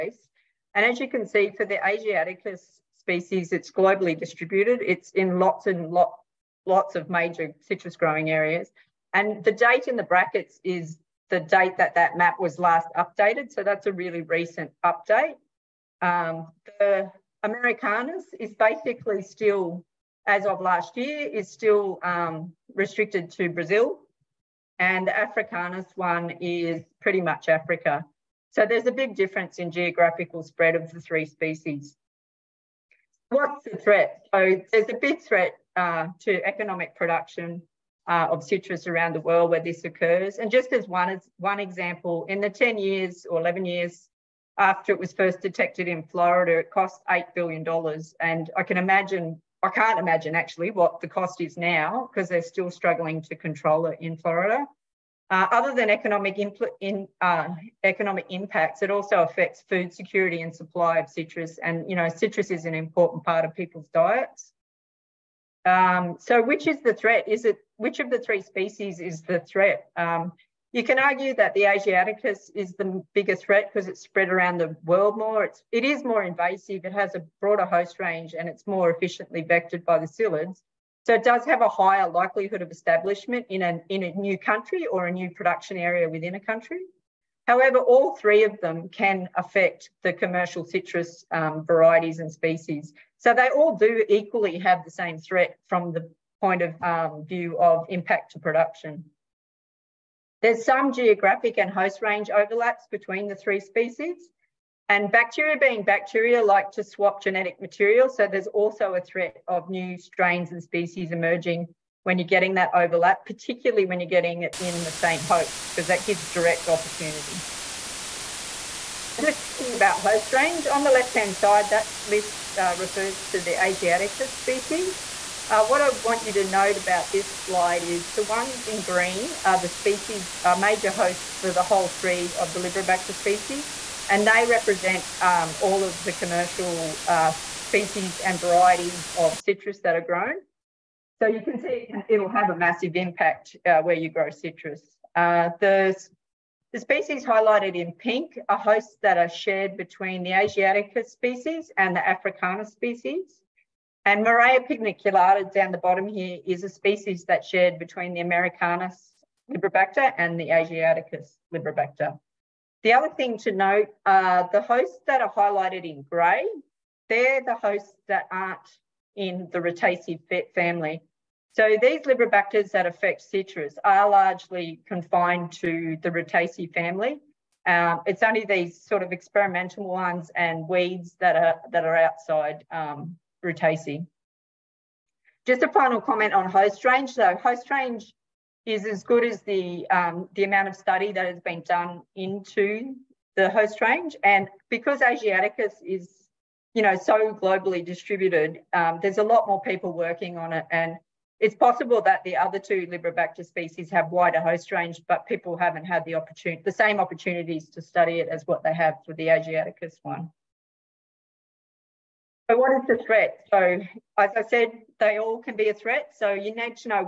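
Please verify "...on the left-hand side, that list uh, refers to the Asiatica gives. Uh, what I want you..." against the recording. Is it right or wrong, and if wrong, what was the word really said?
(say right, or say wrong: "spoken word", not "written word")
wrong: "species", not "gives".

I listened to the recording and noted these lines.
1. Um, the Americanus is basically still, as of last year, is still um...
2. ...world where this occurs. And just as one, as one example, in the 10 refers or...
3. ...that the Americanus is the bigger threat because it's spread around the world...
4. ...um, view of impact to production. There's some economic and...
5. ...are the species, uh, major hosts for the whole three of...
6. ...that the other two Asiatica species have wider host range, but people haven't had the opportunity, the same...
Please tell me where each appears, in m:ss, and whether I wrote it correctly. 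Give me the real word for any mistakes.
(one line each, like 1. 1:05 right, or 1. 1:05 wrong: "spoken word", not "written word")
1. 0:16 right
2. 0:39 wrong: "years", not "refers"
3. 1:11 wrong: "Asiaticus", not "Americanus"
4. 1:36 wrong: "geographic", not "economic"
5. 2:09 right
6. 3:22 wrong: "Liberibacter", not "Asiatica".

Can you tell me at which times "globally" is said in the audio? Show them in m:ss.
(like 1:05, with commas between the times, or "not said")
0:03, 3:17.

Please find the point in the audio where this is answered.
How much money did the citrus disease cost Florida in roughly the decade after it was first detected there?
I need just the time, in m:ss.
0:47.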